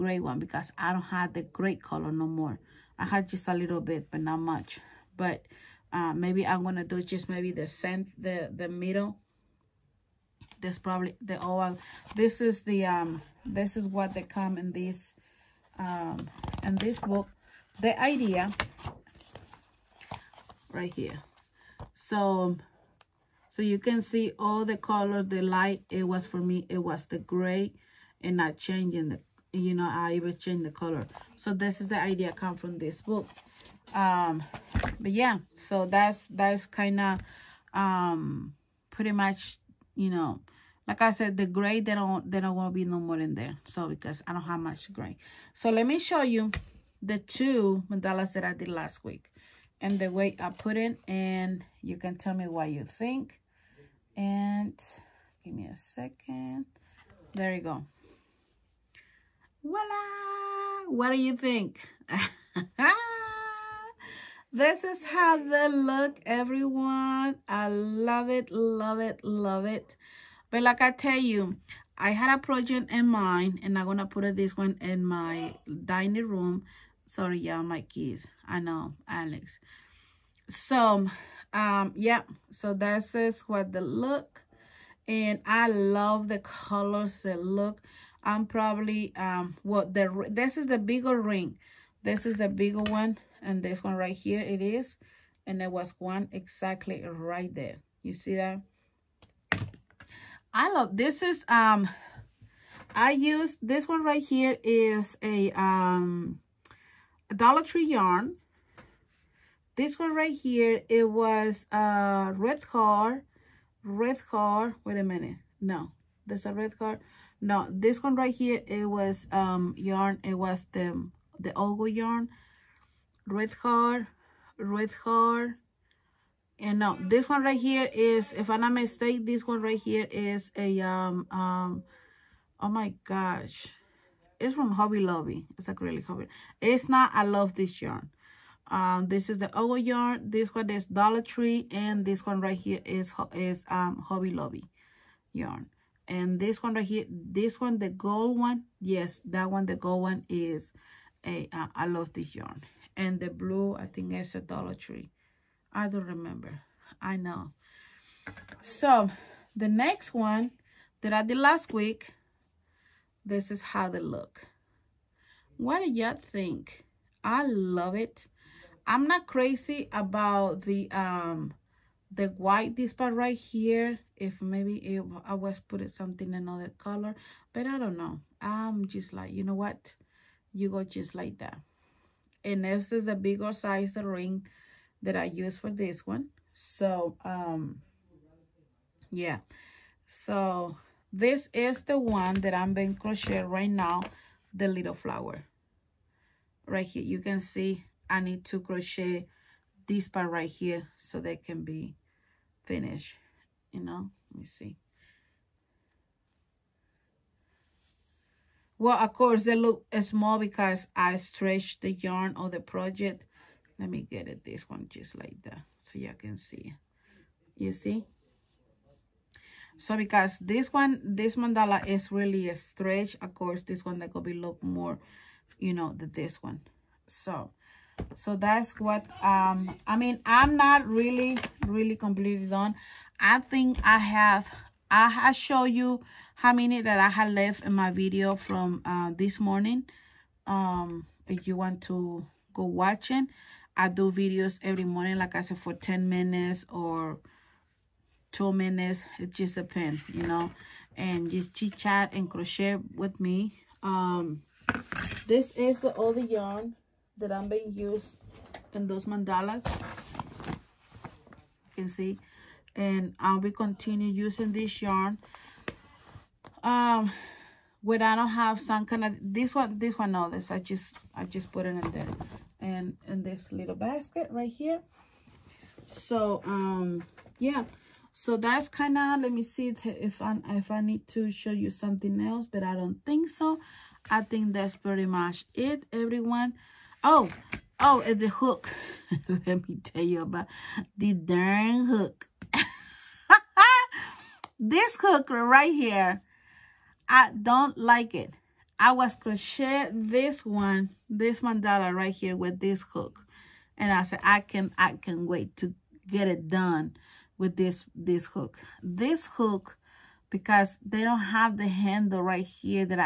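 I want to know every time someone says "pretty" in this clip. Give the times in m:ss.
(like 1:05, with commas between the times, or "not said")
0:38, 4:44.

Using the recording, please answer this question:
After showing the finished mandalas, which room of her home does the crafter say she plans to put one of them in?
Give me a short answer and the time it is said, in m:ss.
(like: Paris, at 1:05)
dining room, at 1:15.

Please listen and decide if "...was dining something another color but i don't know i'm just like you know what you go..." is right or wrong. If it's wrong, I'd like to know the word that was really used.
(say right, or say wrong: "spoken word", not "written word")
wrong: "putting", not "dining".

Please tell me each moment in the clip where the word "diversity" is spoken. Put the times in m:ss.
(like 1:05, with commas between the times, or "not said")
not said.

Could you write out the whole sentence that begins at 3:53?
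I think I have, I have show you how many that I had left in my video from uh, this morning.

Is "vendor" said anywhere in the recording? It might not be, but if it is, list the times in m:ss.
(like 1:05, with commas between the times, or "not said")
not said.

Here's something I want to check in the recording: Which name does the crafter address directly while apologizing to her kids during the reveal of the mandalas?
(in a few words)
Alex.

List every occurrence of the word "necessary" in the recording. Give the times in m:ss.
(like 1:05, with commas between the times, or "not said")
not said.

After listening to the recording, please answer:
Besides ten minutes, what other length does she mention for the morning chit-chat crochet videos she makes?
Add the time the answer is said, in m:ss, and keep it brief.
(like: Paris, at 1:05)
2 minutes, at 4:08.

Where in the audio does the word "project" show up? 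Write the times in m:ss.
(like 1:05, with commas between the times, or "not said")
1:12, 3:32.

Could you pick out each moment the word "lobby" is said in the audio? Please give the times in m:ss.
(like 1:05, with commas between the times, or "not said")
2:15, 2:24.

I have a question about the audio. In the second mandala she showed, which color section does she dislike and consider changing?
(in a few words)
white.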